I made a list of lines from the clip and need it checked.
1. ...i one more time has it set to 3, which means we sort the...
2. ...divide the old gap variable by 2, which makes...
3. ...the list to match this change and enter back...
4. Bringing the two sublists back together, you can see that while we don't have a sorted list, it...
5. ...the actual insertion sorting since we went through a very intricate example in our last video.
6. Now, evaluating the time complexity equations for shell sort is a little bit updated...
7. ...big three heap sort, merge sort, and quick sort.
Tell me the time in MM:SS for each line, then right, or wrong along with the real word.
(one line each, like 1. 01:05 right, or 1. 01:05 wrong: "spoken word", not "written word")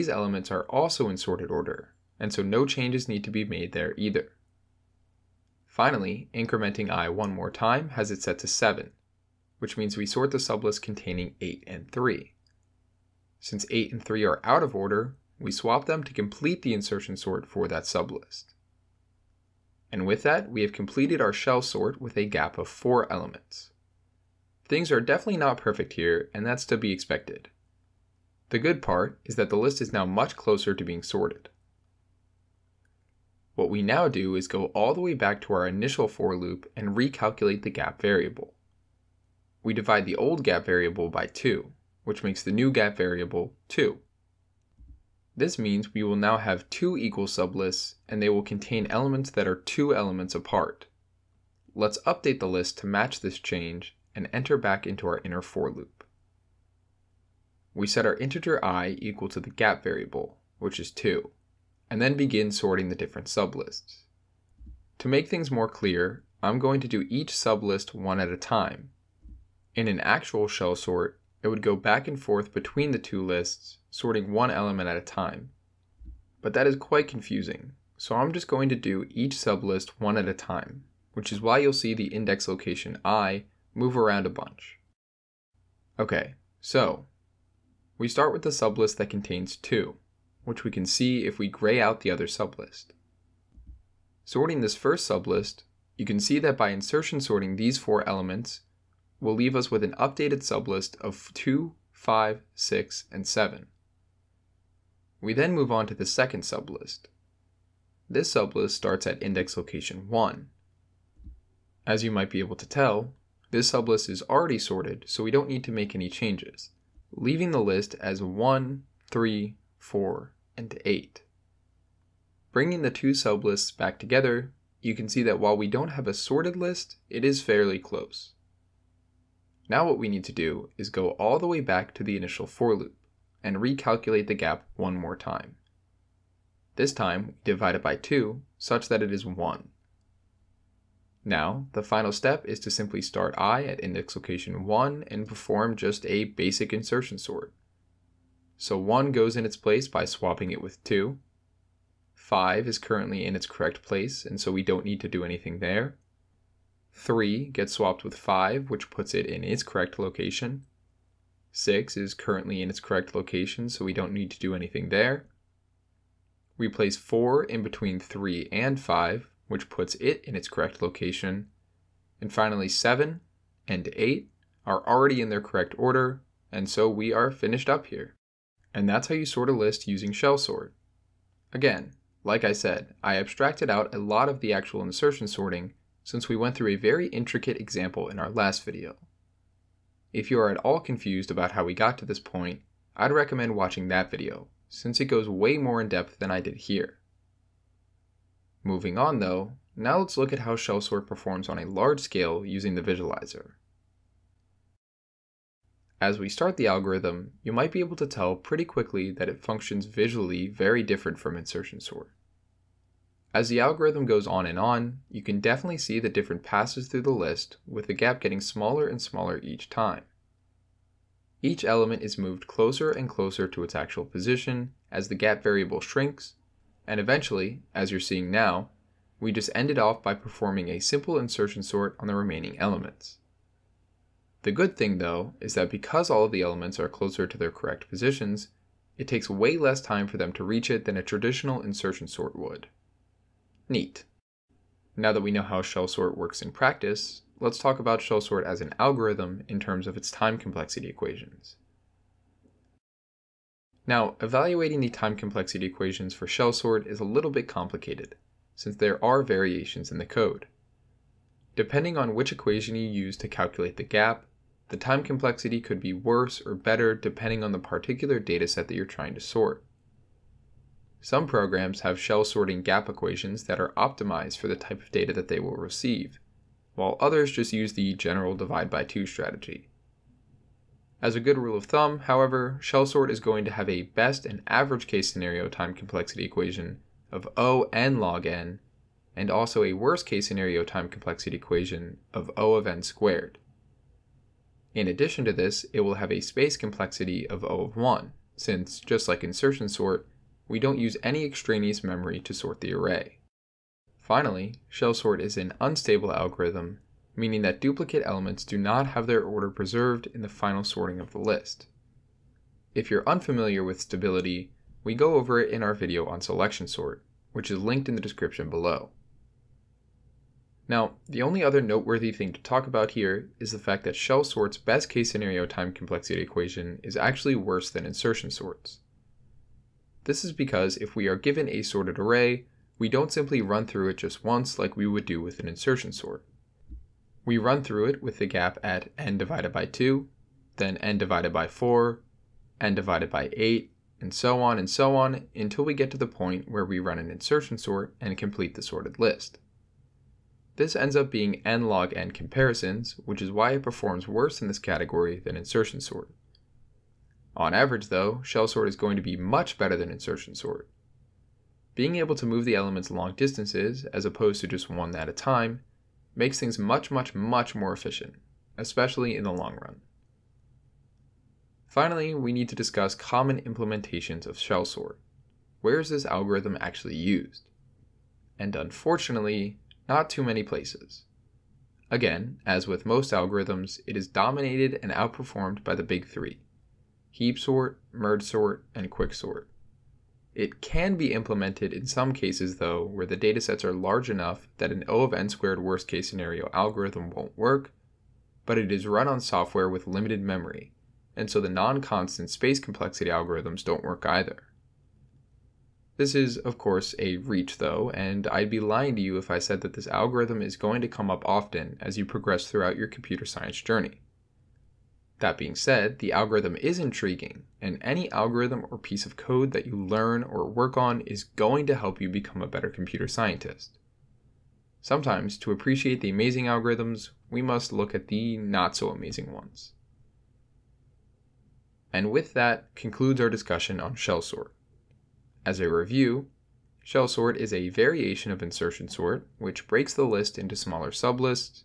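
1. 00:06 wrong: "7", not "3"
2. 00:39 right
3. 00:52 right
4. 02:02 right
5. 03:04 right
6. 04:13 wrong: "complicated", not "updated"
7. 06:25 right.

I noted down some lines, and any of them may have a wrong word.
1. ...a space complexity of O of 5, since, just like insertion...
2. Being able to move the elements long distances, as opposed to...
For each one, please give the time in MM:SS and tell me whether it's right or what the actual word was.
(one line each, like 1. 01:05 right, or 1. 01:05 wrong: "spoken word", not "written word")
1. 04:56 wrong: "1", not "5"
2. 06:01 right.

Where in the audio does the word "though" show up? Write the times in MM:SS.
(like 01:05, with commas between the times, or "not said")
03:19, 03:54, 05:57, 06:32, 06:47.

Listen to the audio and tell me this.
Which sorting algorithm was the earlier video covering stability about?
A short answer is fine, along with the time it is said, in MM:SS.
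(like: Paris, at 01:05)
Selection sort, at 05:16.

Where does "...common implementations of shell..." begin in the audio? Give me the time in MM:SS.
06:12.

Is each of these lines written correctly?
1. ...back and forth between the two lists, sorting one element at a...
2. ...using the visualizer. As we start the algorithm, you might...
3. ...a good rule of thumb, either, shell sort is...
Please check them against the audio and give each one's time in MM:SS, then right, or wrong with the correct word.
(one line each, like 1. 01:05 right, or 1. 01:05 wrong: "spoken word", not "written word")
1. 01:11 right
2. 03:22 right
3. 04:41 wrong: "however", not "either".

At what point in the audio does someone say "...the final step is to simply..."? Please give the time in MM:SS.
02:21.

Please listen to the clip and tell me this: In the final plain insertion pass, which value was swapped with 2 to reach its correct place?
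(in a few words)
1.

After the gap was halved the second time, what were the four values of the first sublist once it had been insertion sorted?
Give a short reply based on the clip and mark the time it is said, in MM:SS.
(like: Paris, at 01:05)
2, 5, 6, and 7, at 01:41.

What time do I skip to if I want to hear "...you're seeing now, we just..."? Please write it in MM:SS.
03:47.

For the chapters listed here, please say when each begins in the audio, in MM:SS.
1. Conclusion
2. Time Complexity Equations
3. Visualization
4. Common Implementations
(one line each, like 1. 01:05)
1. 07:09
2. 04:11
3. 03:24
4. 06:09.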